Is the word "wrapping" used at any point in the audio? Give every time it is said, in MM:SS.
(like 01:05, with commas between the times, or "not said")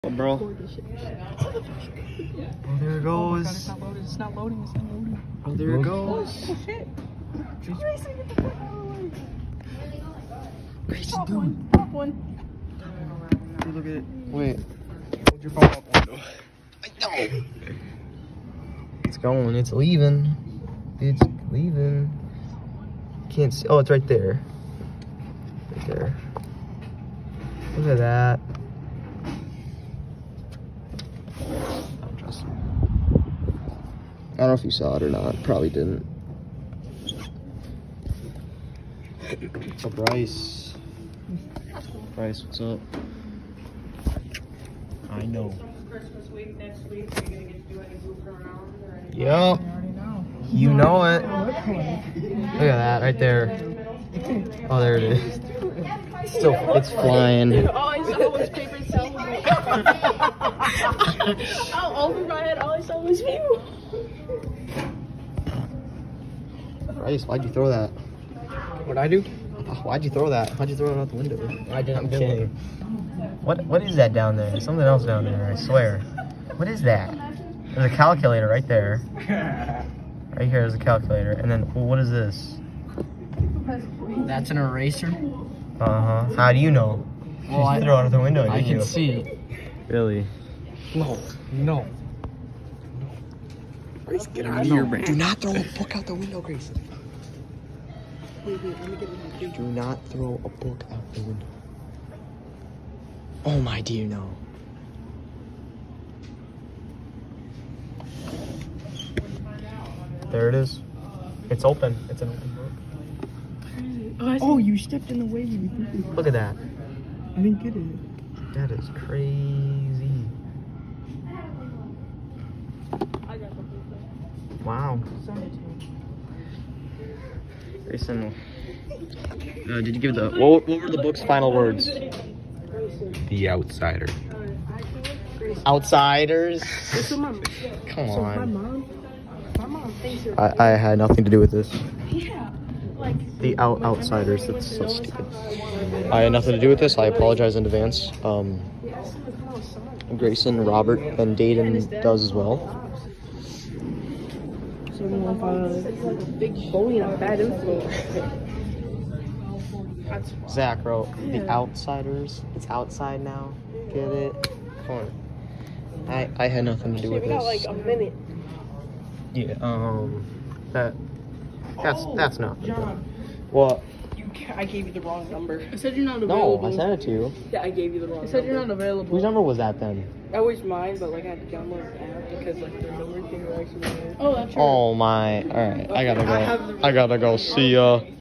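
not said.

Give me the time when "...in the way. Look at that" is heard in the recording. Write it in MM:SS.
01:55.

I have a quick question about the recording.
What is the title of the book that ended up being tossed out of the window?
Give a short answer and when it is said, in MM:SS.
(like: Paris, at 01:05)
The Outsiders, at 02:41.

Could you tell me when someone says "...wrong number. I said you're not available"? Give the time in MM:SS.
02:55.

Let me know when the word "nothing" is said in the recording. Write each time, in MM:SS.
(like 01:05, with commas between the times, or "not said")
02:20, 02:26, 02:46.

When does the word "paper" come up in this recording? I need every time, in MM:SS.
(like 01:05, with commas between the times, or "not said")
00:58.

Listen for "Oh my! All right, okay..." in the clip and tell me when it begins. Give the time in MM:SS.
03:04.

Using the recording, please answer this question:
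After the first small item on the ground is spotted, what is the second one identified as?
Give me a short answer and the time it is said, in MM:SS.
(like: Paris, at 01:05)
an eraser, at 01:24.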